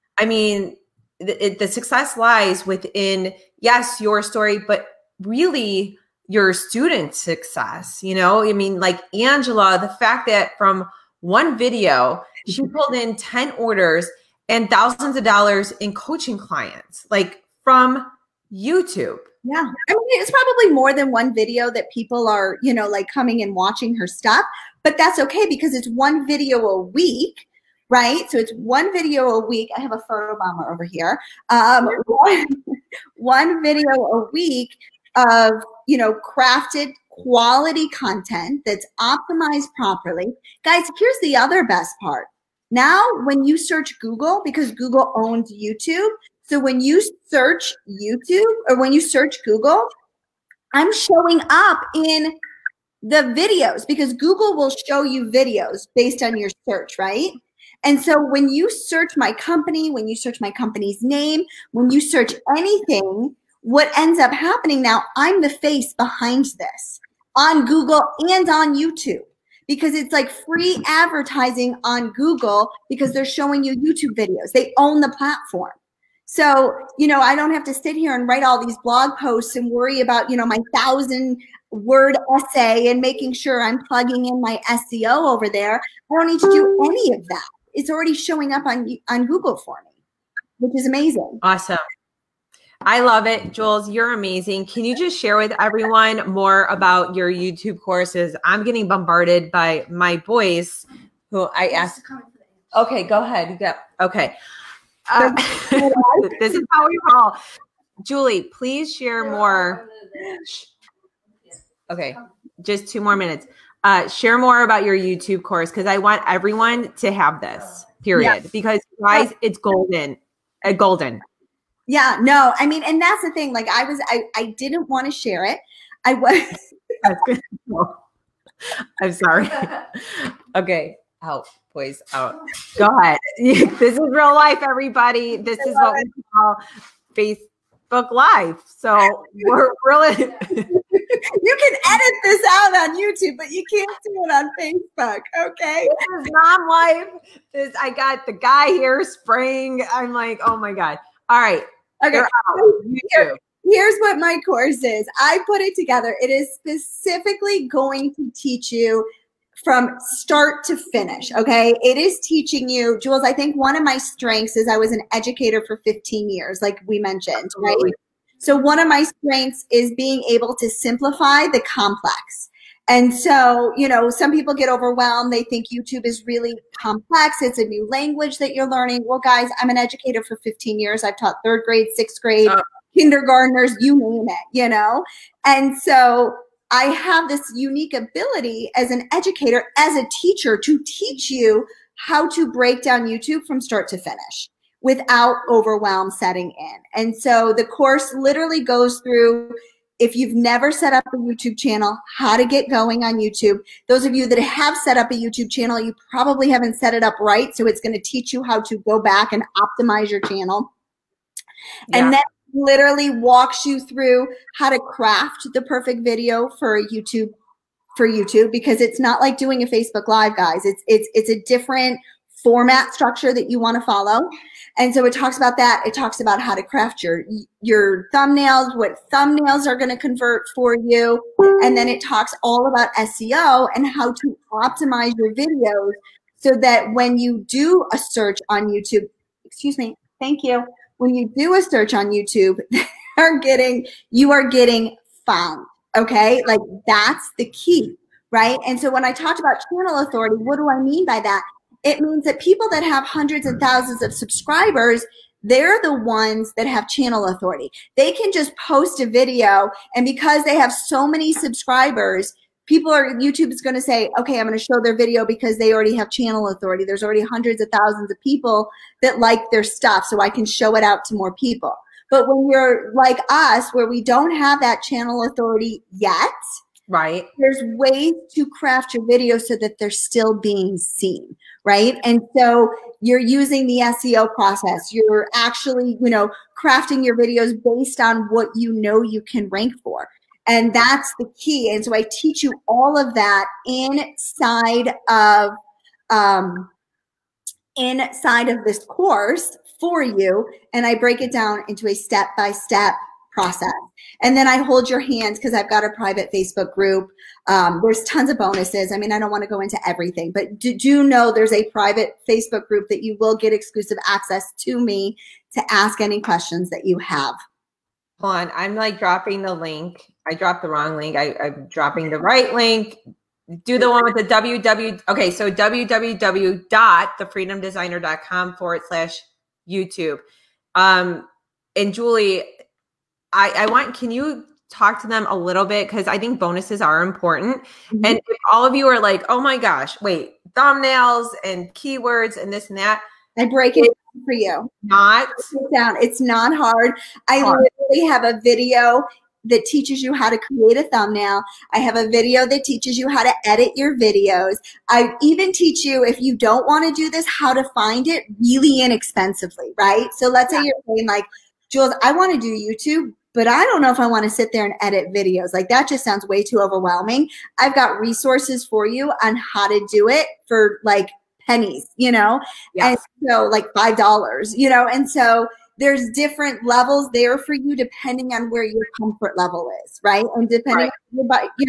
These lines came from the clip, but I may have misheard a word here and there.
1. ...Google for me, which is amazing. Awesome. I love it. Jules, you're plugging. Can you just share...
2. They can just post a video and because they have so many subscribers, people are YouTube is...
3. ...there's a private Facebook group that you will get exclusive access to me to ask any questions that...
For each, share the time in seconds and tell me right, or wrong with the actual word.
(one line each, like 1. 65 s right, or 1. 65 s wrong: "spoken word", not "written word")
1. 89 s wrong: "amazing", not "plugging"
2. 257 s right
3. 311 s right.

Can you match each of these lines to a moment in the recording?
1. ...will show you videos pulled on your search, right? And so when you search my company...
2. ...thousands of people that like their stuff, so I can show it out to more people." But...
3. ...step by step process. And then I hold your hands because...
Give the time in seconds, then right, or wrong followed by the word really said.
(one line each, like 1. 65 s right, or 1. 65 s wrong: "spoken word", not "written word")
1. 54 s wrong: "based", not "pulled"
2. 267 s right
3. 302 s right.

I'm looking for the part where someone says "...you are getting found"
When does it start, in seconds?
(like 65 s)
244 s.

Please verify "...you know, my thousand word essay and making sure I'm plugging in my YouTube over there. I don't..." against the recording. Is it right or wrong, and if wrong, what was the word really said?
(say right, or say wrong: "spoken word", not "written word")
wrong: "SEO", not "YouTube".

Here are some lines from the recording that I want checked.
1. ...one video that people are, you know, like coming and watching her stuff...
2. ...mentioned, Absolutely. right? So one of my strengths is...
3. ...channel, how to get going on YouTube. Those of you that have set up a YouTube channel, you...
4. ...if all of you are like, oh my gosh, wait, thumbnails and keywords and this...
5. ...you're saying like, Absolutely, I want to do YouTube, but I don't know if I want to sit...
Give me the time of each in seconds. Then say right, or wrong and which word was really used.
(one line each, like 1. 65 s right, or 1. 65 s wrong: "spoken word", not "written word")
1. 21 s right
2. 166 s right
3. 201 s right
4. 338 s right
5. 360 s wrong: "Jules", not "Absolutely".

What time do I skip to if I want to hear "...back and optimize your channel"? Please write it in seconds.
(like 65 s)
209 s.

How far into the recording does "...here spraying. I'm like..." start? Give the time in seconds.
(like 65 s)
148 s.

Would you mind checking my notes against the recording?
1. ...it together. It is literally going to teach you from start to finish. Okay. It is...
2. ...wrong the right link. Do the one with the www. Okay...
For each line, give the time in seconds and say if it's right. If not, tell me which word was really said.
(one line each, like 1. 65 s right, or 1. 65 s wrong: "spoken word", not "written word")
1. 155 s wrong: "specifically", not "literally"
2. 321 s wrong: "dropping", not "wrong".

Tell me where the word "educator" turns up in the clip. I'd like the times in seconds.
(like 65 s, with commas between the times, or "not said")
165 s, 179 s, 189 s.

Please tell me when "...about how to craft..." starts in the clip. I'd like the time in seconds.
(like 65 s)
226 s.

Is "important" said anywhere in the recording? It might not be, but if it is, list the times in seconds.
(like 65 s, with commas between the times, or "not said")
337 s.